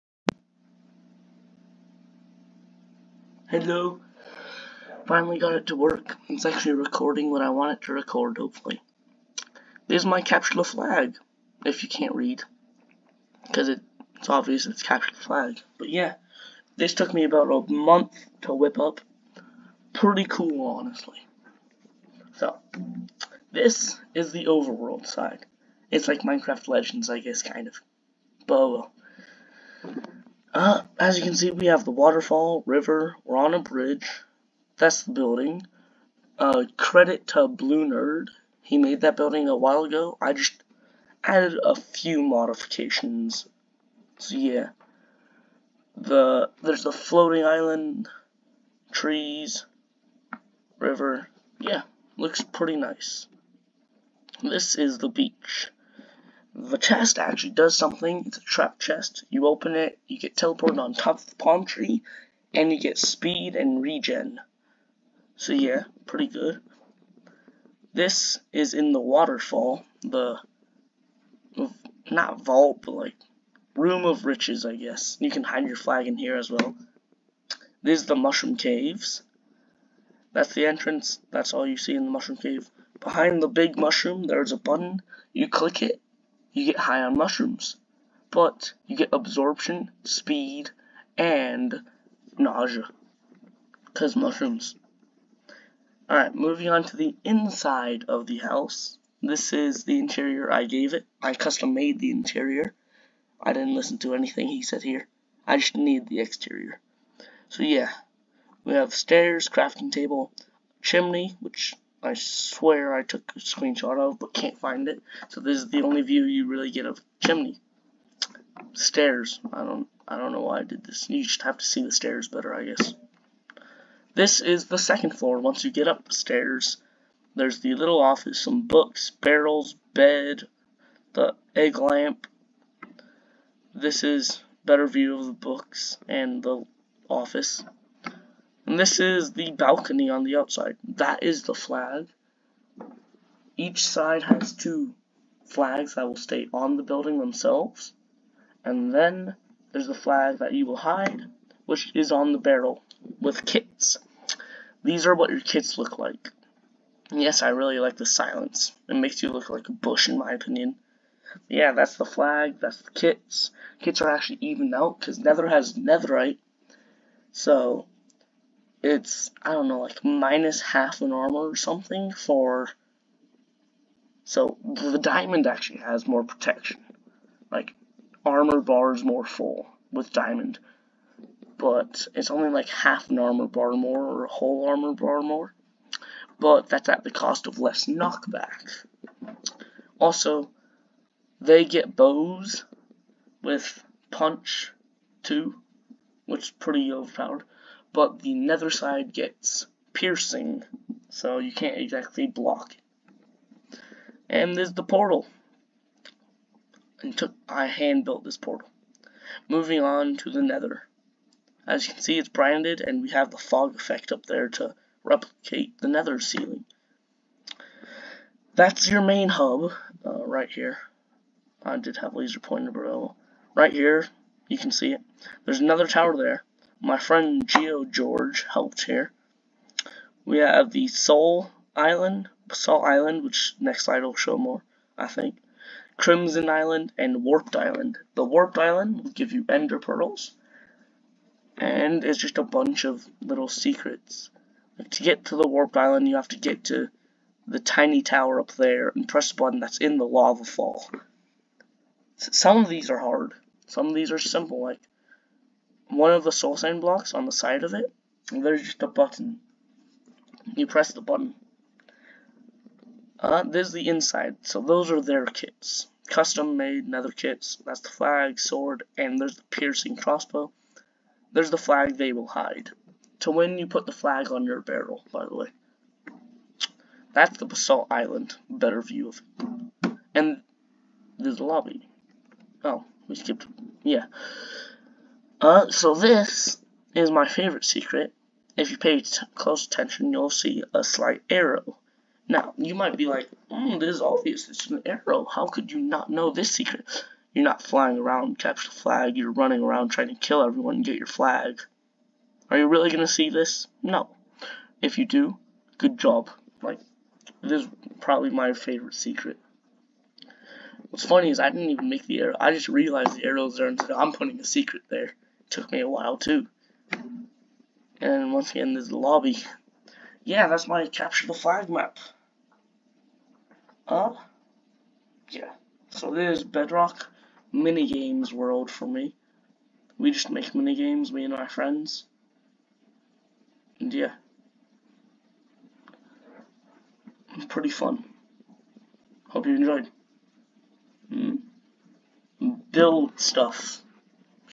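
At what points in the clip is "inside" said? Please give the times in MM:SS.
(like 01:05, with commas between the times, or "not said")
01:37, 04:23.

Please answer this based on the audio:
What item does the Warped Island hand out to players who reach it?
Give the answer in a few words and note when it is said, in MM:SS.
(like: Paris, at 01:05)
Ender Pearls, at 03:59.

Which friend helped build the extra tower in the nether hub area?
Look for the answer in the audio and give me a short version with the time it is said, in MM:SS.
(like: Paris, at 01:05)
GeodeGeorge, at 03:47.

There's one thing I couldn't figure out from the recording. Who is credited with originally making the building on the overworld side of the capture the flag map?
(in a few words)
Blue Nerd.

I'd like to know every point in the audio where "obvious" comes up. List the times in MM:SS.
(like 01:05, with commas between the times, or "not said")
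00:14, 04:54.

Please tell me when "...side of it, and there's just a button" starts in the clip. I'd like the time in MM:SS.
04:17.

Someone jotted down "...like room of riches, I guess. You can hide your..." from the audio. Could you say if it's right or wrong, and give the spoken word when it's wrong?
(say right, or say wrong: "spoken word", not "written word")
right.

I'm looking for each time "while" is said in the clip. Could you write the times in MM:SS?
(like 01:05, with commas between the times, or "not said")
00:39, 05:15.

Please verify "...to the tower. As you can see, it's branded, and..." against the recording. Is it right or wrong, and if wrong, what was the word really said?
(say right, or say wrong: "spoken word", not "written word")
wrong: "nether", not "tower".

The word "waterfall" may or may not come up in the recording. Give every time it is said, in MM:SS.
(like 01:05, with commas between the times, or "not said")
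00:31, 01:08.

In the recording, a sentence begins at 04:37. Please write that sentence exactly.
That's the Basalt Island, better view of it.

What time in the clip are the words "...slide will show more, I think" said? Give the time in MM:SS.
03:53.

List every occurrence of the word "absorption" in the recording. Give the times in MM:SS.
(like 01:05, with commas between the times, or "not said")
01:29.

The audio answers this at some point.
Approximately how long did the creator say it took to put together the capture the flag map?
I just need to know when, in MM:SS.
00:17.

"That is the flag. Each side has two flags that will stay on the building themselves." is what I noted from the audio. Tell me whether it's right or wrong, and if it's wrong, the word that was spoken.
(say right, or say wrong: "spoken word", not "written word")
right.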